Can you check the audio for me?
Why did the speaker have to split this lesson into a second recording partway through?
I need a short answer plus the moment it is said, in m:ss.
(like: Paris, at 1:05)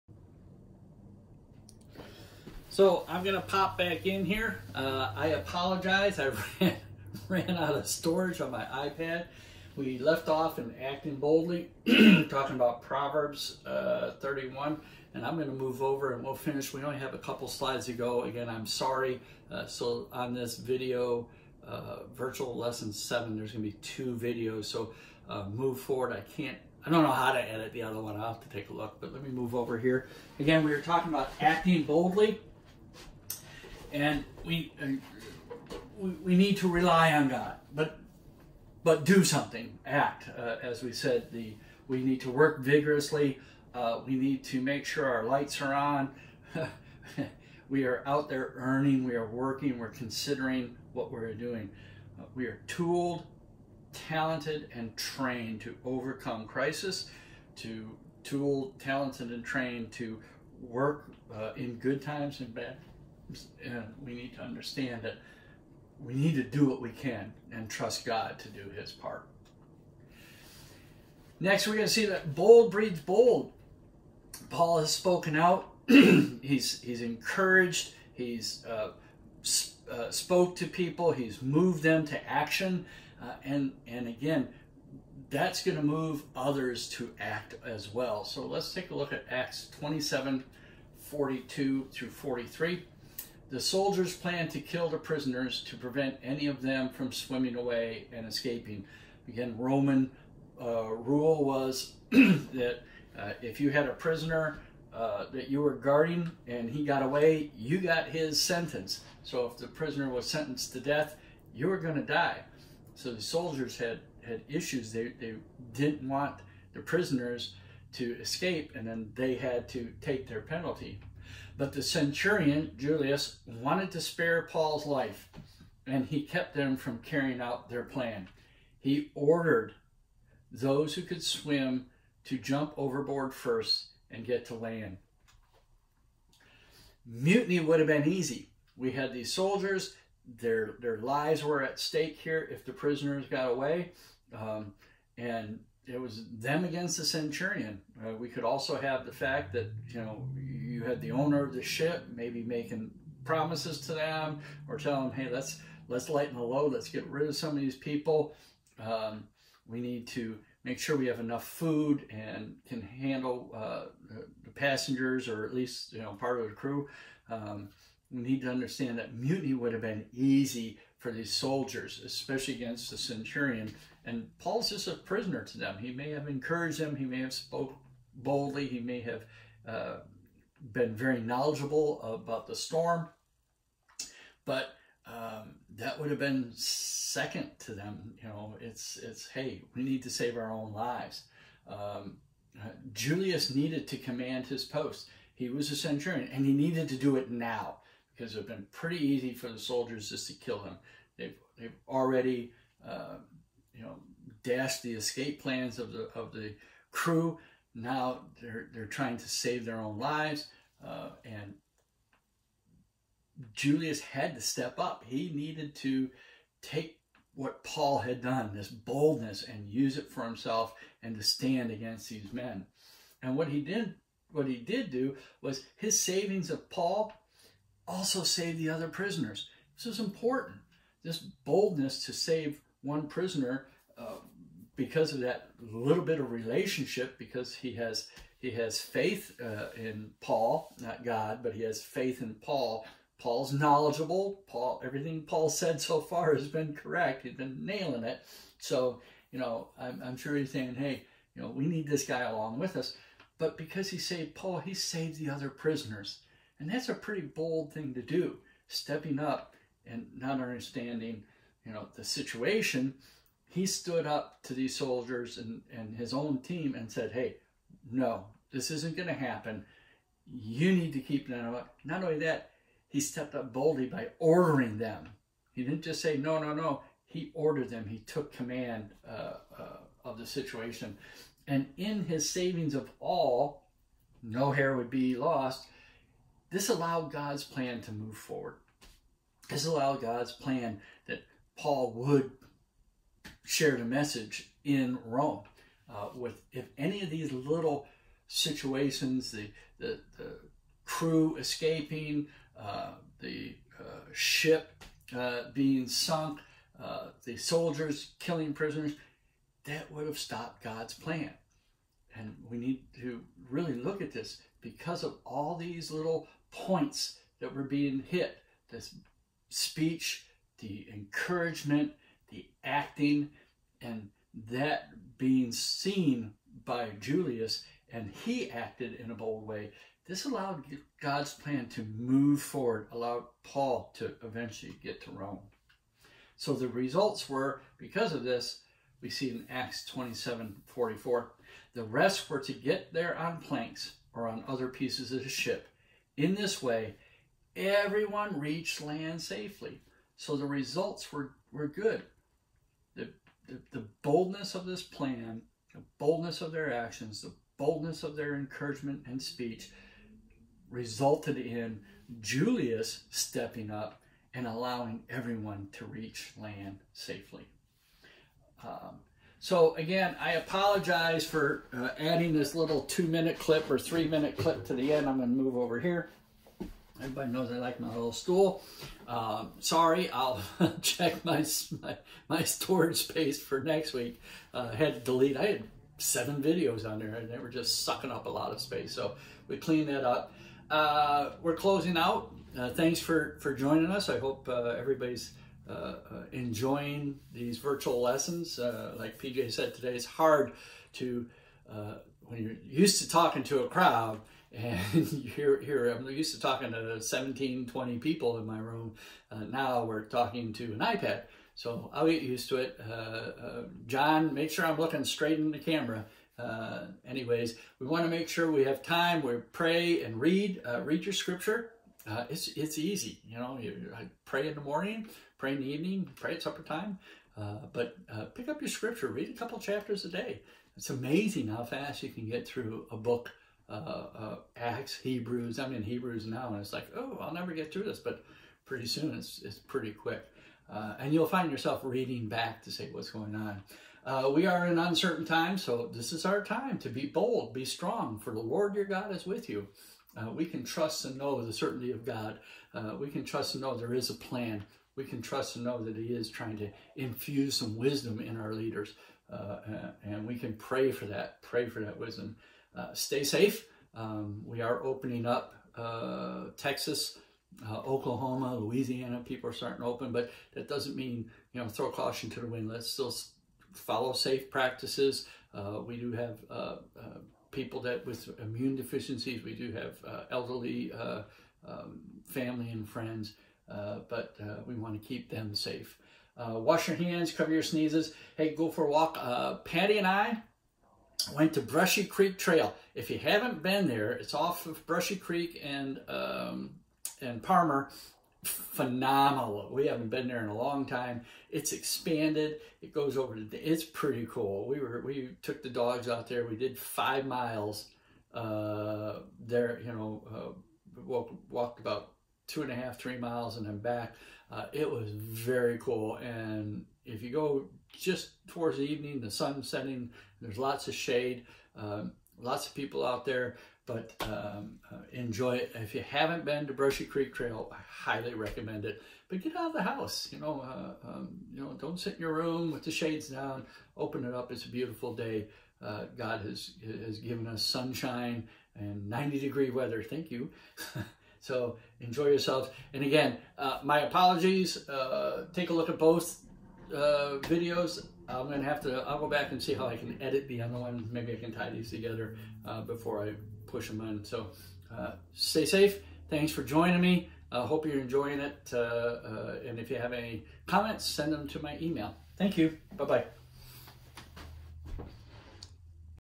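Ran out of storage, at 0:07.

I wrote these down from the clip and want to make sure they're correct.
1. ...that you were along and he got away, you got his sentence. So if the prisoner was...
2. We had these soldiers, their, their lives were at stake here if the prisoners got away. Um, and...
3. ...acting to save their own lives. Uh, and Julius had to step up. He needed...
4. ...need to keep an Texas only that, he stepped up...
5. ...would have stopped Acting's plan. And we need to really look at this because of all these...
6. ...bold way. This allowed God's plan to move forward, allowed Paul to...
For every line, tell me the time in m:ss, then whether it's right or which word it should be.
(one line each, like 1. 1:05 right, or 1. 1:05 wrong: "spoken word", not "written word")
1. 1:45 wrong: "guarding", not "along"
2. 2:18 right
3. 3:28 wrong: "trying", not "acting"
4. 4:30 wrong: "Not", not "Texas"
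5. 5:09 wrong: "God", not "Acting"
6. 5:29 right.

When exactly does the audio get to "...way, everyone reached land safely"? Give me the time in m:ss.
5:46.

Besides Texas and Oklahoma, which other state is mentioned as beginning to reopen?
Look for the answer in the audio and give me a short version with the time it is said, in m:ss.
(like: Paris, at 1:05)
Louisiana, at 7:48.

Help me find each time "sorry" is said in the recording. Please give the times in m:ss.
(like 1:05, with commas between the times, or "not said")
0:18, 6:19.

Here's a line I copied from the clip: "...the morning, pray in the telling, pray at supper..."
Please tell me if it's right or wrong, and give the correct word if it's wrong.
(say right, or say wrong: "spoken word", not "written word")
wrong: "evening", not "telling".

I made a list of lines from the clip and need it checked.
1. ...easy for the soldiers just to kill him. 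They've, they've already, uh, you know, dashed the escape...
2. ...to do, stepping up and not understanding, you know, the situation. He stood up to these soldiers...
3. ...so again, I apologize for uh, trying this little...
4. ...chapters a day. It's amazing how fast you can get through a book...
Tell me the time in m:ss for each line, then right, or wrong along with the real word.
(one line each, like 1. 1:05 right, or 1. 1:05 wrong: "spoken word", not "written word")
1. 3:19 right
2. 4:17 right
3. 6:09 wrong: "adding", not "trying"
4. 7:09 right.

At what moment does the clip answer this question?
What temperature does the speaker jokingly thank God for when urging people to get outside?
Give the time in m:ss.
8:59.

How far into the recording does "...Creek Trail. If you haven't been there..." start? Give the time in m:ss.
8:12.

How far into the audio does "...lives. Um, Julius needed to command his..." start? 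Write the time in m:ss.
3:10.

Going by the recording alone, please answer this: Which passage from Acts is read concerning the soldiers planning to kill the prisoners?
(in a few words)
Acts 27:42-43.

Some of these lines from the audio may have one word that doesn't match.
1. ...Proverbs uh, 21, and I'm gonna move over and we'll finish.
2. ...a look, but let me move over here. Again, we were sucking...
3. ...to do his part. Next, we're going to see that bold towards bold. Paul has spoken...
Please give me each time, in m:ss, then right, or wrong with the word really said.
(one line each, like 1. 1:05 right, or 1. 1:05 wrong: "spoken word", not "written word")
1. 0:12 wrong: "31", not "21"
2. 0:28 wrong: "talking", not "sucking"
3. 1:08 wrong: "breeds", not "towards".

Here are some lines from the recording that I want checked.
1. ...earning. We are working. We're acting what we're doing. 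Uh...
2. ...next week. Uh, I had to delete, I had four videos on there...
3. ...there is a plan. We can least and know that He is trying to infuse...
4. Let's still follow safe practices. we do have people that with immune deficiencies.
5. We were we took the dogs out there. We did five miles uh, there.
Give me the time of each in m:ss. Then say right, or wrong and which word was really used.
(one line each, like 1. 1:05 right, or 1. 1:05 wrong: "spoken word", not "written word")
1. 0:48 wrong: "considering", not "acting"
2. 6:23 wrong: "seven", not "four"
3. 7:33 wrong: "trust", not "least"
4. 7:52 right
5. 8:24 right.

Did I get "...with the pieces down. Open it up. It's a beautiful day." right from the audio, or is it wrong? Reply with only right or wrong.
wrong.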